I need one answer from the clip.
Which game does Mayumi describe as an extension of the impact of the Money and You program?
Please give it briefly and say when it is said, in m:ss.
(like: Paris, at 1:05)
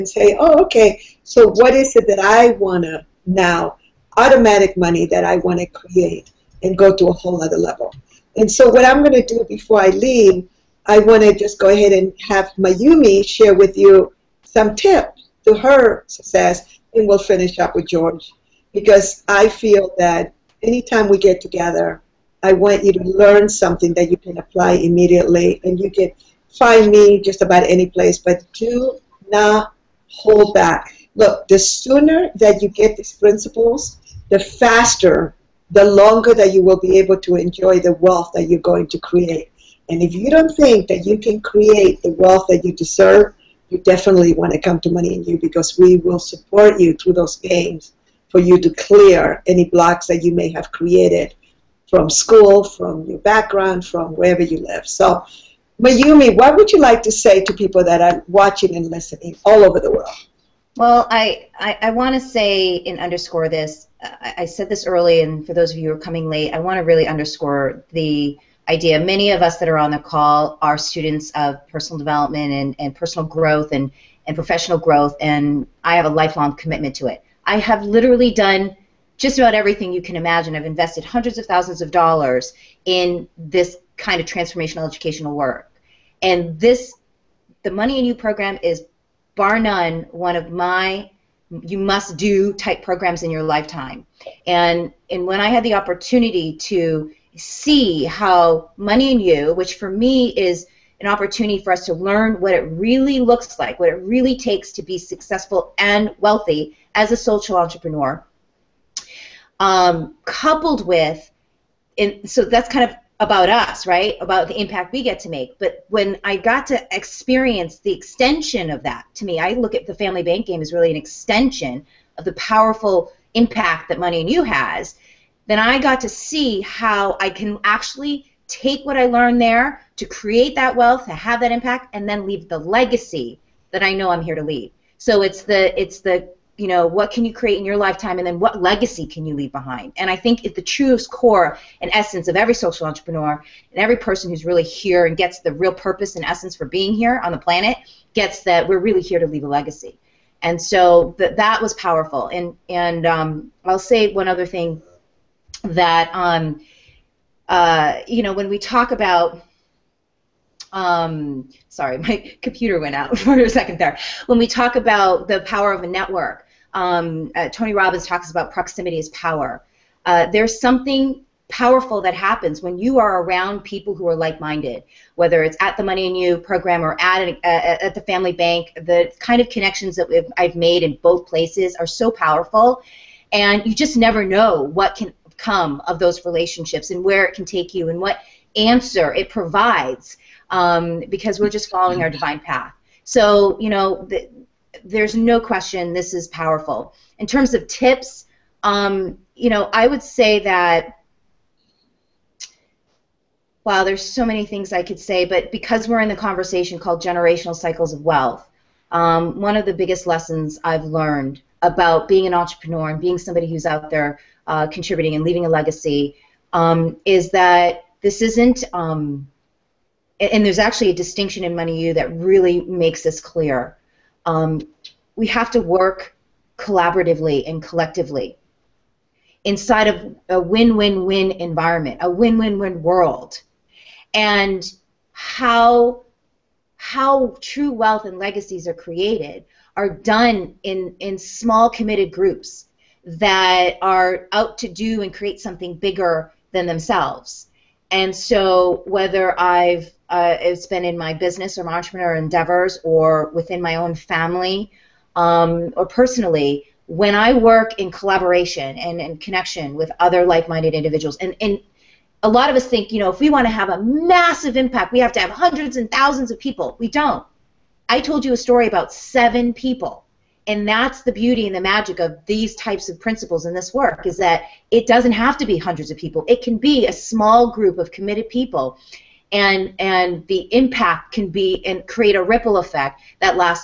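family bank game, at 1:59.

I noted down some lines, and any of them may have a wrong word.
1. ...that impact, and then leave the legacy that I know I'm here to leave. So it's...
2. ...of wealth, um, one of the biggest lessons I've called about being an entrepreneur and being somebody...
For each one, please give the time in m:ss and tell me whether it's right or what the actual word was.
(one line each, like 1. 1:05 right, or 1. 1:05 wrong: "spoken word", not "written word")
1. 2:11 right
2. 3:27 wrong: "learned", not "called".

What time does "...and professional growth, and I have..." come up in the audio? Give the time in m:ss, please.
1:14.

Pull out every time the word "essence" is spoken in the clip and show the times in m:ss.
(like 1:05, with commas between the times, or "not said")
2:21, 2:26.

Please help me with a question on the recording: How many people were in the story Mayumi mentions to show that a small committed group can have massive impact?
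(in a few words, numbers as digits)
7.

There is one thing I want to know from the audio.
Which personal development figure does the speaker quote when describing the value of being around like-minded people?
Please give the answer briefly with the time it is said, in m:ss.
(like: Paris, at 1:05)
Tony Robbins, at 2:47.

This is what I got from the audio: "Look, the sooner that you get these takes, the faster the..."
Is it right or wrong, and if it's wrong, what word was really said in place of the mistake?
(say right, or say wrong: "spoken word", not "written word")
wrong: "principles", not "takes".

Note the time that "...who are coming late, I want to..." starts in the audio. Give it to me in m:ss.
1:05.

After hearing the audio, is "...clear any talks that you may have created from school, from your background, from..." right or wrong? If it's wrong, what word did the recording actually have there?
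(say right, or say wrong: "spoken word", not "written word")
wrong: "blocks", not "talks".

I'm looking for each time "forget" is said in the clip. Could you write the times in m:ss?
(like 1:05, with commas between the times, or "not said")
not said.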